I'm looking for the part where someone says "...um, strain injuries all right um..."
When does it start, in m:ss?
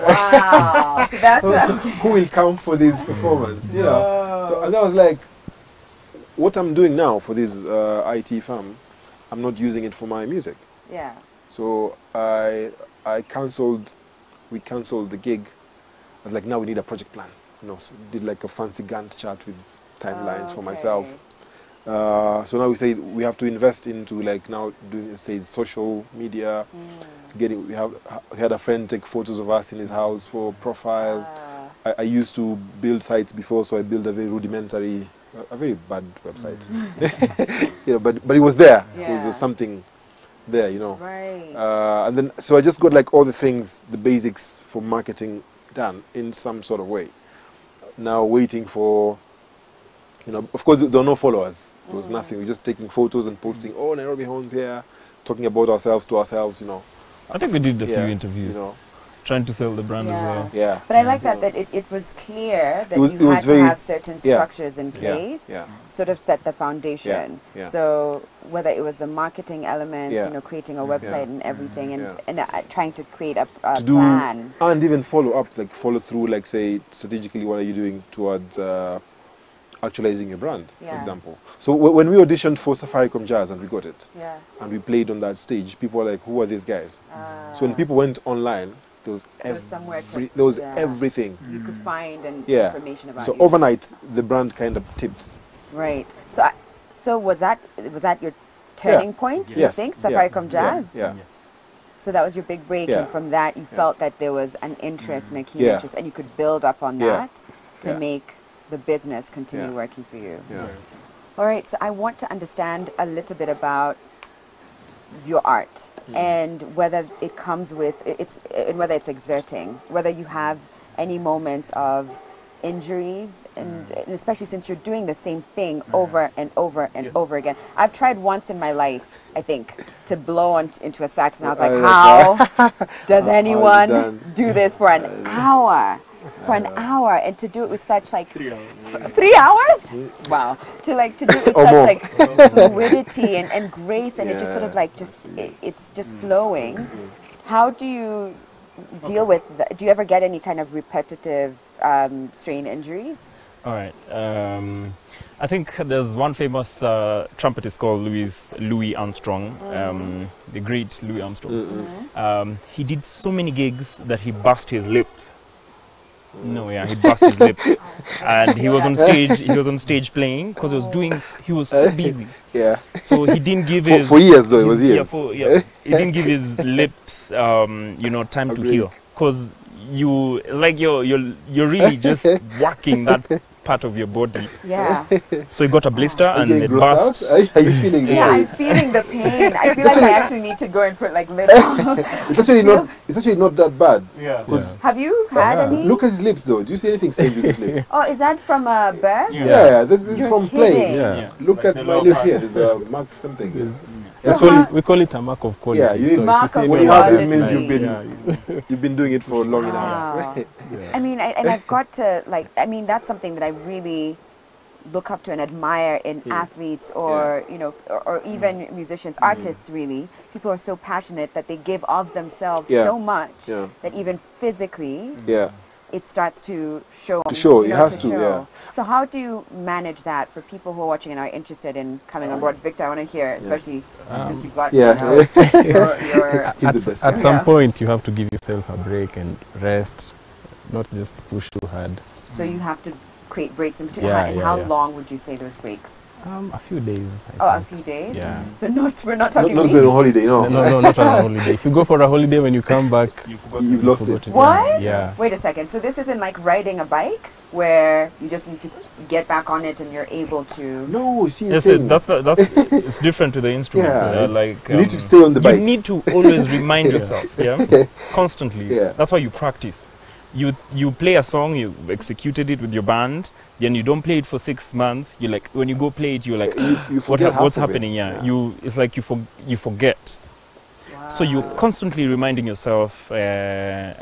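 2:31.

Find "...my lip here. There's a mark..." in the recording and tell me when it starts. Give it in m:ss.
3:21.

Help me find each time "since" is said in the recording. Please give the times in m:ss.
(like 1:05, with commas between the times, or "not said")
2:04, 3:54.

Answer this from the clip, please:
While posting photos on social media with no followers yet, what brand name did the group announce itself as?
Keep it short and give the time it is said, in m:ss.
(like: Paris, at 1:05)
Nairobi Horns, at 0:53.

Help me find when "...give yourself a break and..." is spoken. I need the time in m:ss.
3:58.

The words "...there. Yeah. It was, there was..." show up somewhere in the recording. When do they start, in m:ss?
0:38.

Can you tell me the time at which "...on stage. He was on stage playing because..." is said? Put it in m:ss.
2:48.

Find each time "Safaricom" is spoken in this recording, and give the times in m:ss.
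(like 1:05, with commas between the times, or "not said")
1:22, 1:39.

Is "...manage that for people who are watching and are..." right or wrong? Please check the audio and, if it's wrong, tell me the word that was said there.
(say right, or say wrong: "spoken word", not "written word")
right.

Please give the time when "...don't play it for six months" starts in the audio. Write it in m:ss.
4:33.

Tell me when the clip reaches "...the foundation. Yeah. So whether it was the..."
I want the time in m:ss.
1:06.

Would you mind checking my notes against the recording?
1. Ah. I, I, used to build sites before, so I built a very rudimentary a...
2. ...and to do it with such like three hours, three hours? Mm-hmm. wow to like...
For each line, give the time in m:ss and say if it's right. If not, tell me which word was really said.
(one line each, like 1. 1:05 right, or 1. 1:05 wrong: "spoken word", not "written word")
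1. 0:31 right
2. 2:17 right.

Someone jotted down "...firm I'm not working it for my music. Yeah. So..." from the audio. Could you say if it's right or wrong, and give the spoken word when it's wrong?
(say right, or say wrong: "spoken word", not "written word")
wrong: "using", not "working".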